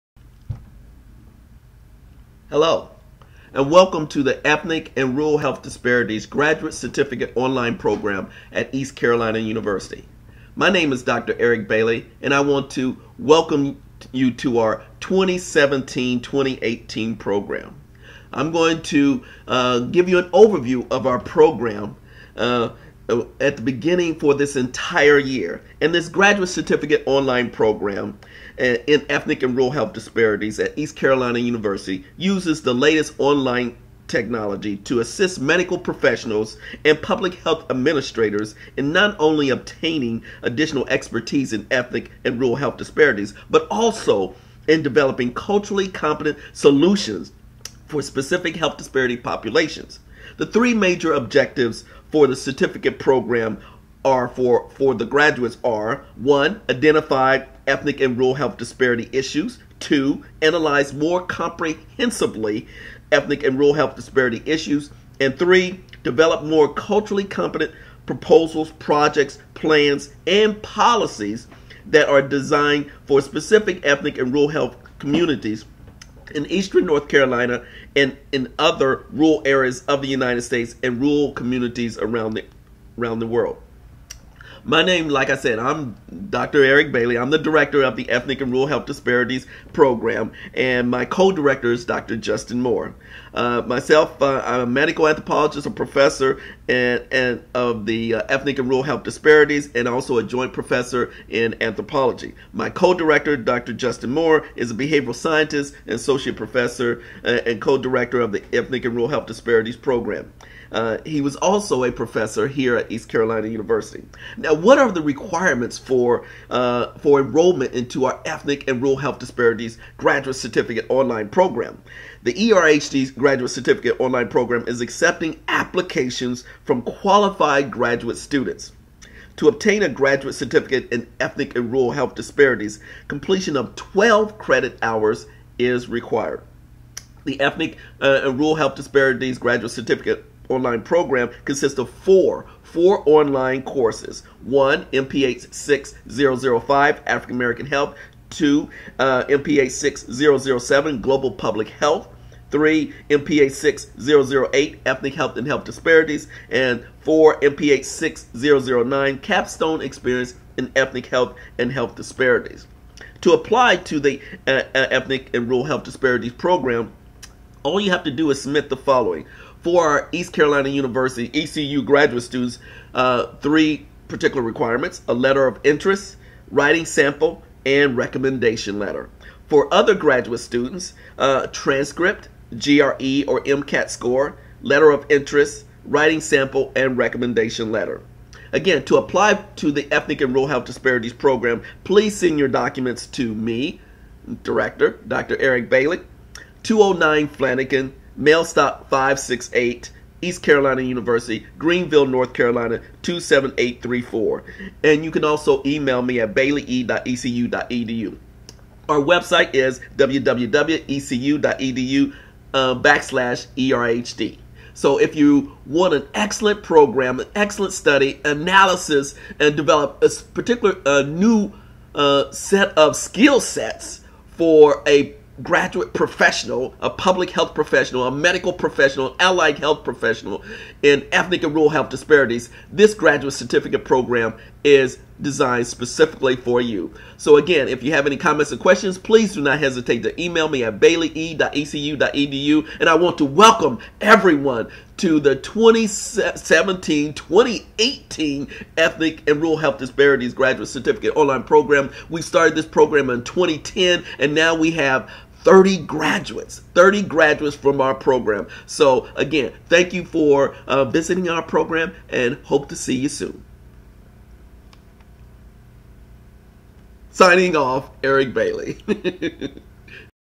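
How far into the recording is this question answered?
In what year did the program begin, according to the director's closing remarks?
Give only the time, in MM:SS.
04:13.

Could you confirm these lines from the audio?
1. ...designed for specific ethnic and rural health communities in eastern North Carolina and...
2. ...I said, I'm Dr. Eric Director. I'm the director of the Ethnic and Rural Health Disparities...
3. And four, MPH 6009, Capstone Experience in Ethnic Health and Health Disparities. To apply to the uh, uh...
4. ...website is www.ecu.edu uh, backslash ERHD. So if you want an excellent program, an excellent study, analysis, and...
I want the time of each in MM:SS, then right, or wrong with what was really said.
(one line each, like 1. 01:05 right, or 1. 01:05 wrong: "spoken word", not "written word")
1. 01:12 right
2. 01:25 wrong: "Bailey", not "Director"
3. 02:36 right
4. 03:28 right.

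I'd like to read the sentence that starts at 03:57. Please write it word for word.
So again, if you have any comments or questions, please do not hesitate to email me at baileye.ecu.edu.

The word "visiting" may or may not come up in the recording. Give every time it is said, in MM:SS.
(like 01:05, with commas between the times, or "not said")
04:20.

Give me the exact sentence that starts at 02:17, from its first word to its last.
The Ethnic uh, and Rural Health Disparities Graduate Certificate online program consists of four four online courses.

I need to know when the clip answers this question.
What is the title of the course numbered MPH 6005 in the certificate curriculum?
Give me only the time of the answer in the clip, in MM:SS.
02:27.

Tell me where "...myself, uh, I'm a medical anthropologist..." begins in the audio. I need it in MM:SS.
01:33.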